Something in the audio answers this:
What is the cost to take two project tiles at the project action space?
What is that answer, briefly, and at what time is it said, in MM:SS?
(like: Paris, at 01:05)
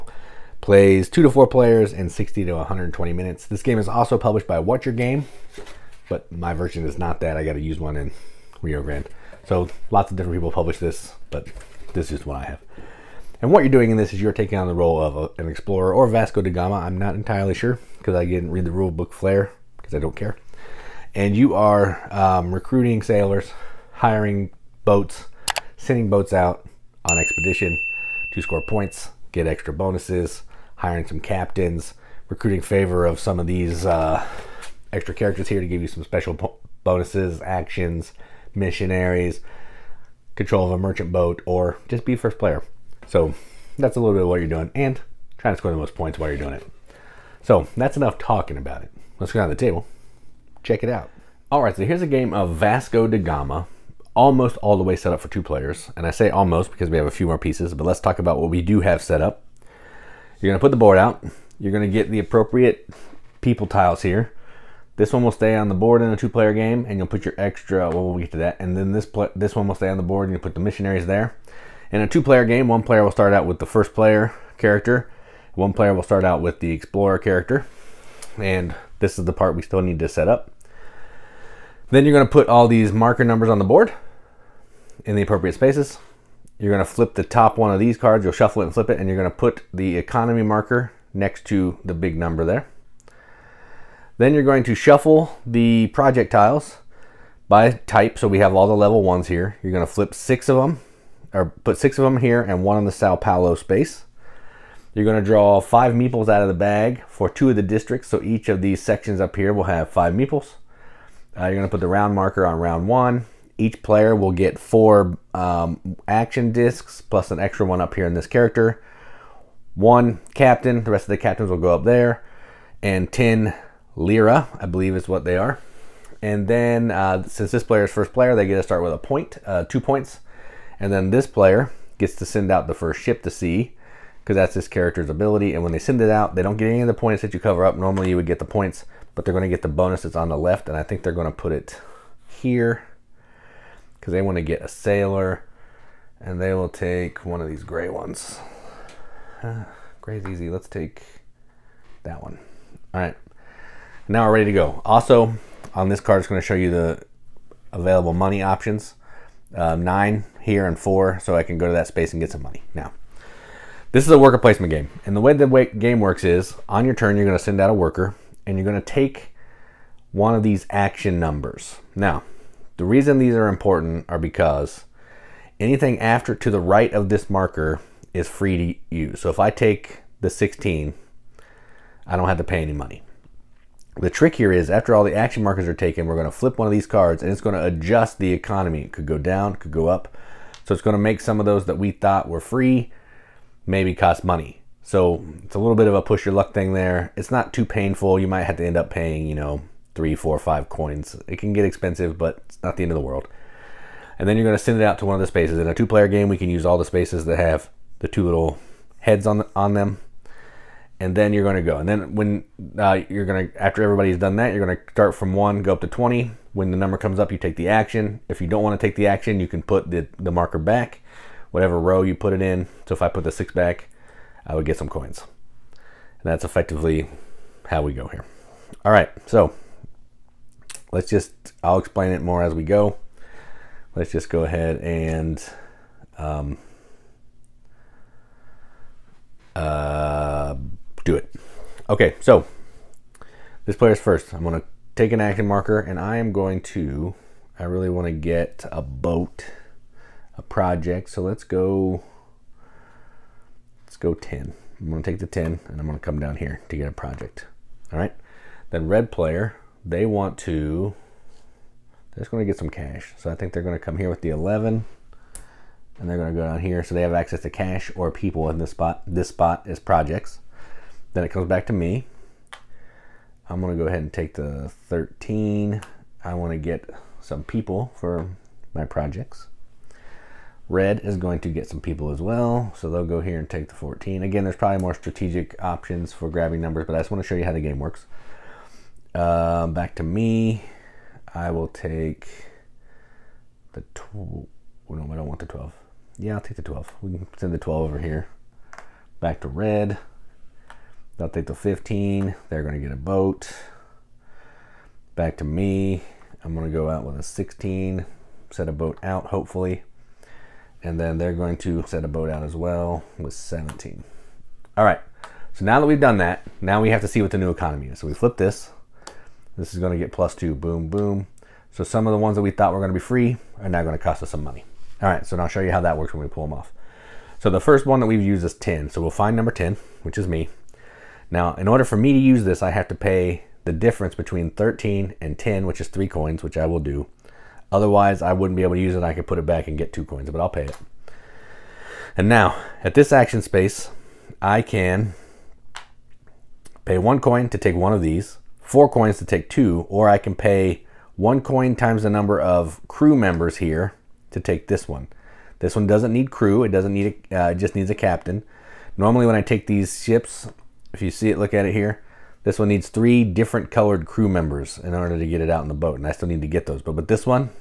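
4 coins, at 05:48.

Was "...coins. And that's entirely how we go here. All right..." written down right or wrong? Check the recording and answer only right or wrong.
wrong.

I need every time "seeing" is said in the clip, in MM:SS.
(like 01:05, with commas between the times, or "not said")
not said.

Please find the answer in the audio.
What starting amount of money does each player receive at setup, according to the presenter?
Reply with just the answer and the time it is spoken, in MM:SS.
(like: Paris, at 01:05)
10 lira, at 02:03.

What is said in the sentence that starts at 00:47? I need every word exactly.
So that's enough talking about it.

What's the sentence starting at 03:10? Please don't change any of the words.
So it's going to make some of those that we thought were free maybe cost money.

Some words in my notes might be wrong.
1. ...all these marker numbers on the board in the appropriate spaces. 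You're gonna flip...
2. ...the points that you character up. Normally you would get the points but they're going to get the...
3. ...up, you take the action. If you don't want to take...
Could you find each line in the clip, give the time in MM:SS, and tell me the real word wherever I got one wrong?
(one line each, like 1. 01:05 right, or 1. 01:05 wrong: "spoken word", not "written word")
1. 01:22 right
2. 02:16 wrong: "cover", not "character"
3. 03:37 right.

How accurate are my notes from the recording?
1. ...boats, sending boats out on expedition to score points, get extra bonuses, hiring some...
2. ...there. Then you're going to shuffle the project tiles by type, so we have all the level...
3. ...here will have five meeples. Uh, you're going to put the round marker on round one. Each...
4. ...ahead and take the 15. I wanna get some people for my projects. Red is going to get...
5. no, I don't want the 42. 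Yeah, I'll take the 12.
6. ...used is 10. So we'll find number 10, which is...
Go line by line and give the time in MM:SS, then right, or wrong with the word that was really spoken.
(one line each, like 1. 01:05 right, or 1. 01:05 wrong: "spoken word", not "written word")
1. 00:24 right
2. 01:32 right
3. 01:49 right
4. 04:33 wrong: "13", not "15"
5. 04:54 wrong: "12", not "42"
6. 05:28 right.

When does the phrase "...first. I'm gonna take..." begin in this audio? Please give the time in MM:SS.
04:04.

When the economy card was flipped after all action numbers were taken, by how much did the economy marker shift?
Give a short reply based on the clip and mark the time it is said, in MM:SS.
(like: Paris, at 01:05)
Plus 2, at 05:20.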